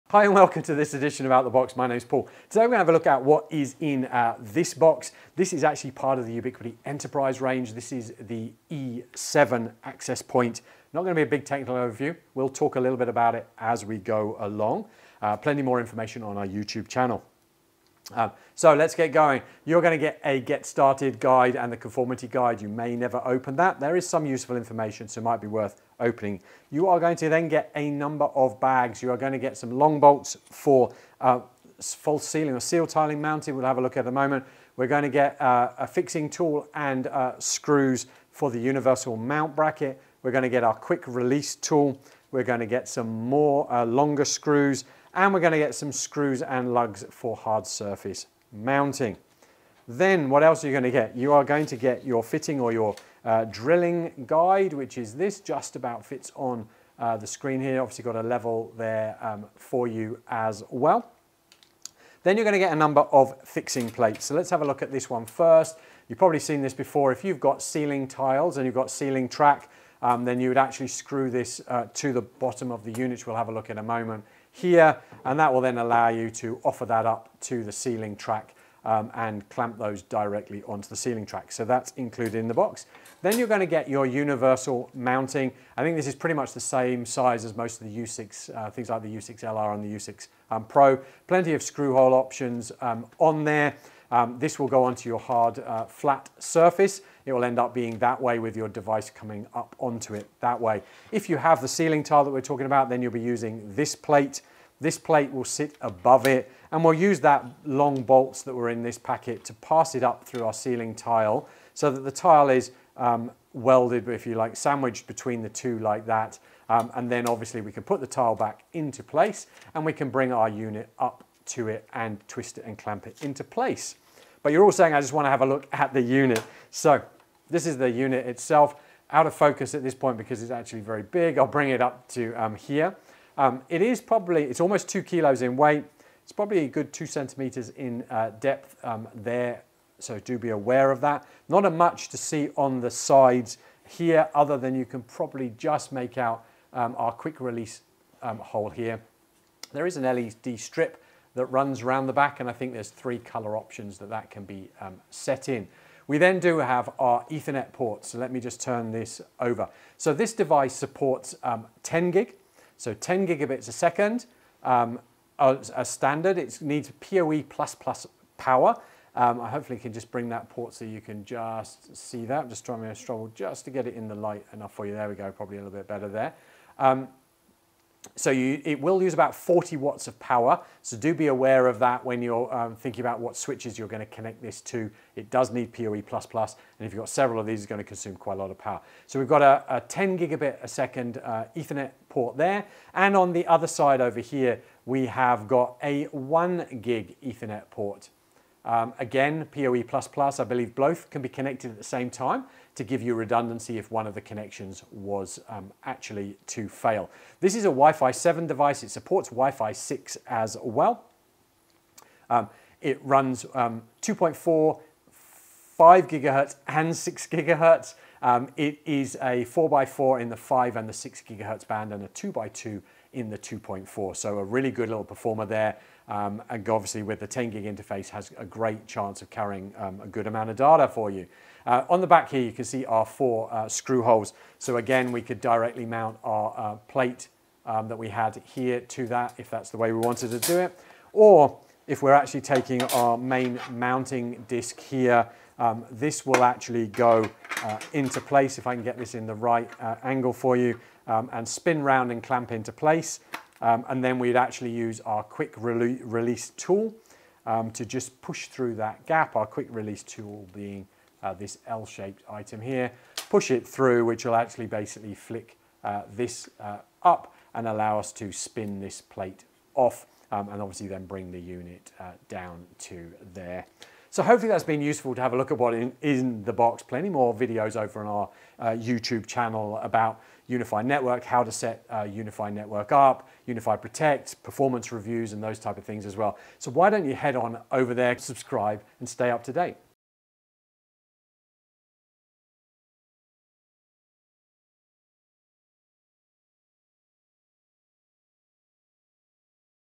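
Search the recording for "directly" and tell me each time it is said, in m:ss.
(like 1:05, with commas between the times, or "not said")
1:20, 3:55.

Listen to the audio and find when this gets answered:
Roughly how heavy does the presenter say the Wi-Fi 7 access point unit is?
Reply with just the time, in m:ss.
2:14.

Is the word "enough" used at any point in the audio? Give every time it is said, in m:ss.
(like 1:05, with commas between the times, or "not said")
2:54.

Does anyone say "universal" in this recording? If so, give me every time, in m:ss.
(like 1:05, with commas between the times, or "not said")
0:38, 1:24.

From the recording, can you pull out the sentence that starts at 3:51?
Uh, on the back here, you can see our four uh, screw holes.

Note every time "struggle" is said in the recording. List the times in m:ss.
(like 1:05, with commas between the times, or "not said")
2:52.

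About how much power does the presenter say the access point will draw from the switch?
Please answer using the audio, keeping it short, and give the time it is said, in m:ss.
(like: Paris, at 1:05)
40 watts, at 2:59.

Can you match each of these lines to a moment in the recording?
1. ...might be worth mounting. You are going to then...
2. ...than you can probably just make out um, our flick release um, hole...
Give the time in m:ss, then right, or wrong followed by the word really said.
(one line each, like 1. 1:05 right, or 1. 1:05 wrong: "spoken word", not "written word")
1. 0:25 wrong: "opening", not "mounting"
2. 2:24 wrong: "quick", not "flick".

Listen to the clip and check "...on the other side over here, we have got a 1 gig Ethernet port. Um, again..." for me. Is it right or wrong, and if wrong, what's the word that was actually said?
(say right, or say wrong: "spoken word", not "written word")
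right.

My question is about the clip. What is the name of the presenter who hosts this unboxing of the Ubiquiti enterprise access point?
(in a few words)
Paul.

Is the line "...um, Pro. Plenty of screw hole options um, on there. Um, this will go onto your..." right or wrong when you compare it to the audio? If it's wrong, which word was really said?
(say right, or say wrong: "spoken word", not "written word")
right.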